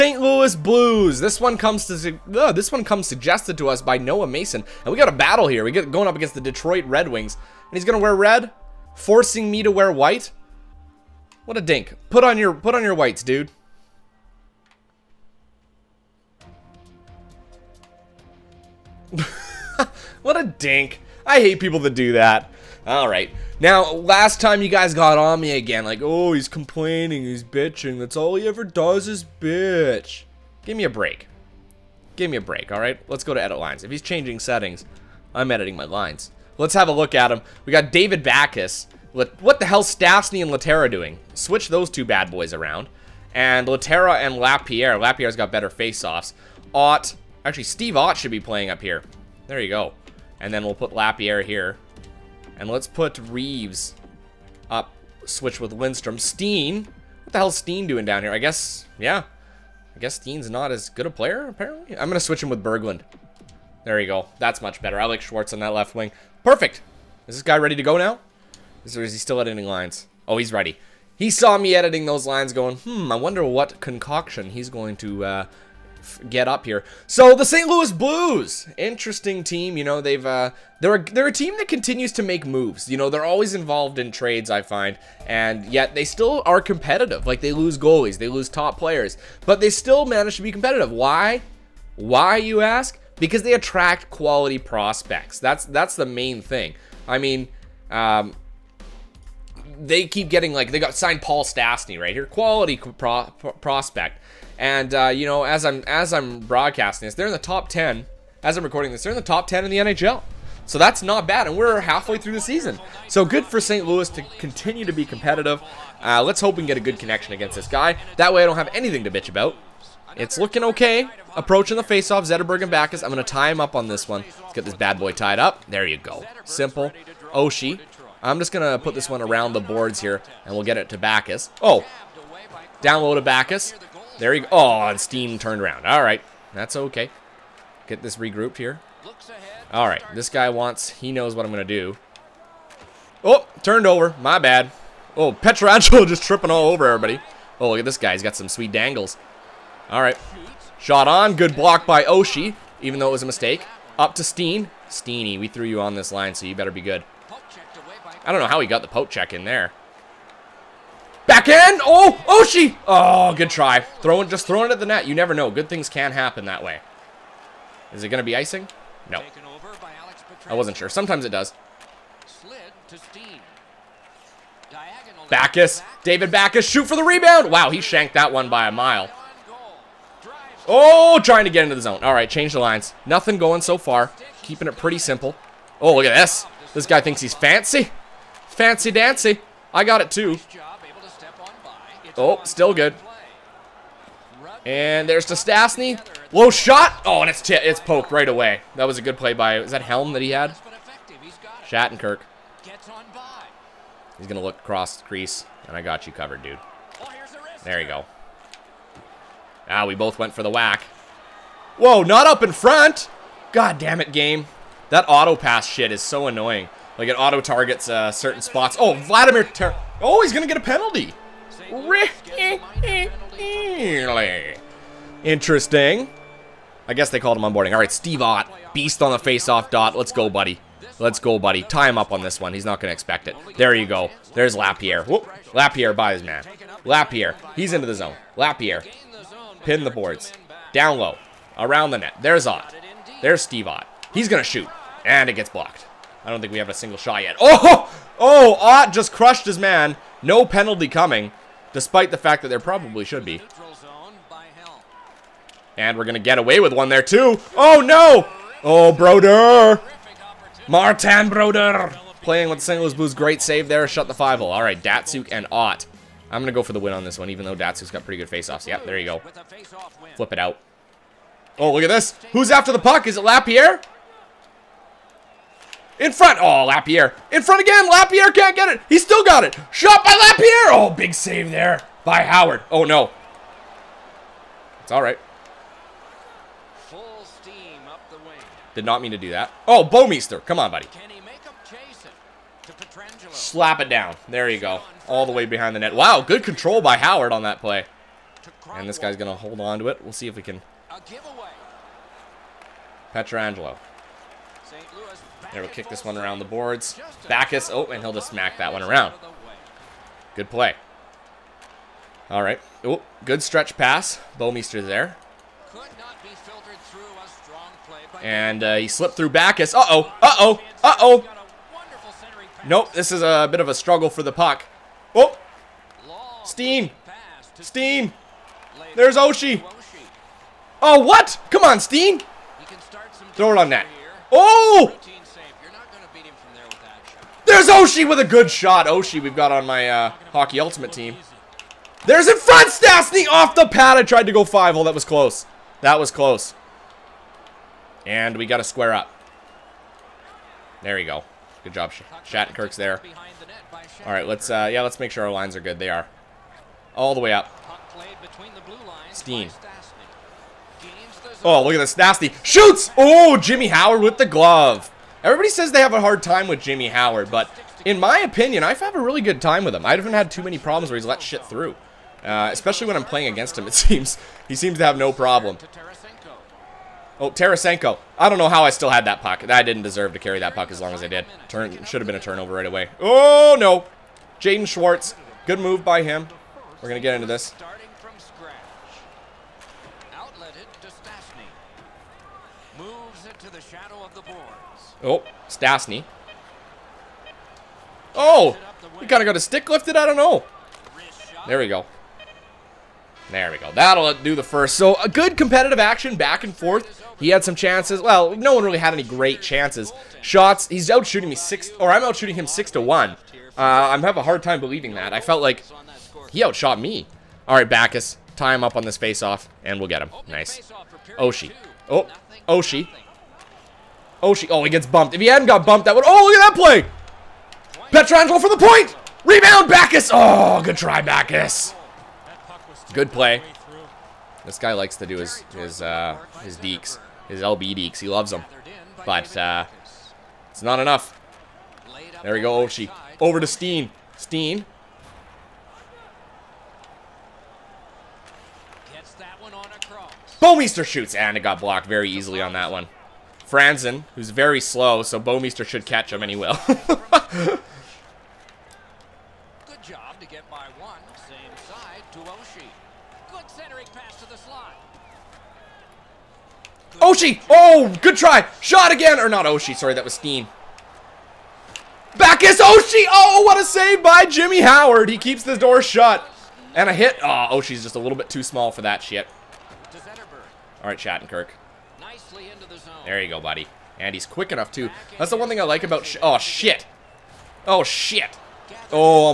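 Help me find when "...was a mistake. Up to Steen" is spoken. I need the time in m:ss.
2:33.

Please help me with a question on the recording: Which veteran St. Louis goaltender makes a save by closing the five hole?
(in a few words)
Martin Brodeur.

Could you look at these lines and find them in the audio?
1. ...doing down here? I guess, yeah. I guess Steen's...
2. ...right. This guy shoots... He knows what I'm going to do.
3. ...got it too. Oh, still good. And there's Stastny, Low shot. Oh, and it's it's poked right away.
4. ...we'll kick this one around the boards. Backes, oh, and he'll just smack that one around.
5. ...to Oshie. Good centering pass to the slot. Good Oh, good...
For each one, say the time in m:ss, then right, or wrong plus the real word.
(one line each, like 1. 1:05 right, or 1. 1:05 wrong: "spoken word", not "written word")
1. 0:57 right
2. 2:19 wrong: "wants", not "shoots"
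3. 3:09 right
4. 5:05 right
5. 7:42 right.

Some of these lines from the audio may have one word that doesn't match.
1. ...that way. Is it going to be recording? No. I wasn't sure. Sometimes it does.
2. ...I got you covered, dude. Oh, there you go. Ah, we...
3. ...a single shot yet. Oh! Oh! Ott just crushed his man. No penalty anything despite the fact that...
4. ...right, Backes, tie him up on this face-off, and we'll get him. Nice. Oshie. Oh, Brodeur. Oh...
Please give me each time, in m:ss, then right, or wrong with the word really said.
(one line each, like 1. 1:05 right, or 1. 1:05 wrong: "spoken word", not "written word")
1. 2:46 wrong: "icing", not "recording"
2. 3:25 right
3. 4:06 wrong: "coming", not "anything"
4. 6:57 wrong: "Oshie", not "Brodeur".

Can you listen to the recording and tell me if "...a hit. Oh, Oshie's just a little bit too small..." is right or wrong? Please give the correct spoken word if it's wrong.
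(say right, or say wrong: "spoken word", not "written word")
right.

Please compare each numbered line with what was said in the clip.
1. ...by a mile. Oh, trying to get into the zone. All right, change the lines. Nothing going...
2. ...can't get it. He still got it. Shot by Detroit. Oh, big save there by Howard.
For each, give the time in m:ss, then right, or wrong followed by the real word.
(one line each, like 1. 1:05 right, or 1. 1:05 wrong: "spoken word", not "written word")
1. 2:58 right
2. 4:38 wrong: "Lapierre", not "Detroit".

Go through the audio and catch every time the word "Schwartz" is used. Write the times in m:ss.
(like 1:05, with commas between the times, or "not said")
1:05, 6:24.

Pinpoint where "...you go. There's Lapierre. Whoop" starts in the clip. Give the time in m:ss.
3:53.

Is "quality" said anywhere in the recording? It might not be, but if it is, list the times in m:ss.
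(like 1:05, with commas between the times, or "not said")
1:34, 1:42.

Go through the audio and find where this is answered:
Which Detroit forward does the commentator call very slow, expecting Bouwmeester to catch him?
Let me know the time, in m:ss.
7:33.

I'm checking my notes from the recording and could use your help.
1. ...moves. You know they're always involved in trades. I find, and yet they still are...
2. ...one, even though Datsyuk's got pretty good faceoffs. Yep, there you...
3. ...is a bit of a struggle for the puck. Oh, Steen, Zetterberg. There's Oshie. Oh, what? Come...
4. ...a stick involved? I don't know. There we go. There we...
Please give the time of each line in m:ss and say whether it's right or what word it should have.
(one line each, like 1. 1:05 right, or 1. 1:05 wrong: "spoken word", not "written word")
1. 1:22 right
2. 4:27 right
3. 5:23 wrong: "Steen", not "Zetterberg"
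4. 6:39 wrong: "lifted", not "involved".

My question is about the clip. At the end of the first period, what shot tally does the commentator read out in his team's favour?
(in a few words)
6 to 1.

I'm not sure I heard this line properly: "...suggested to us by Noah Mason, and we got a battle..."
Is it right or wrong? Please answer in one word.
right.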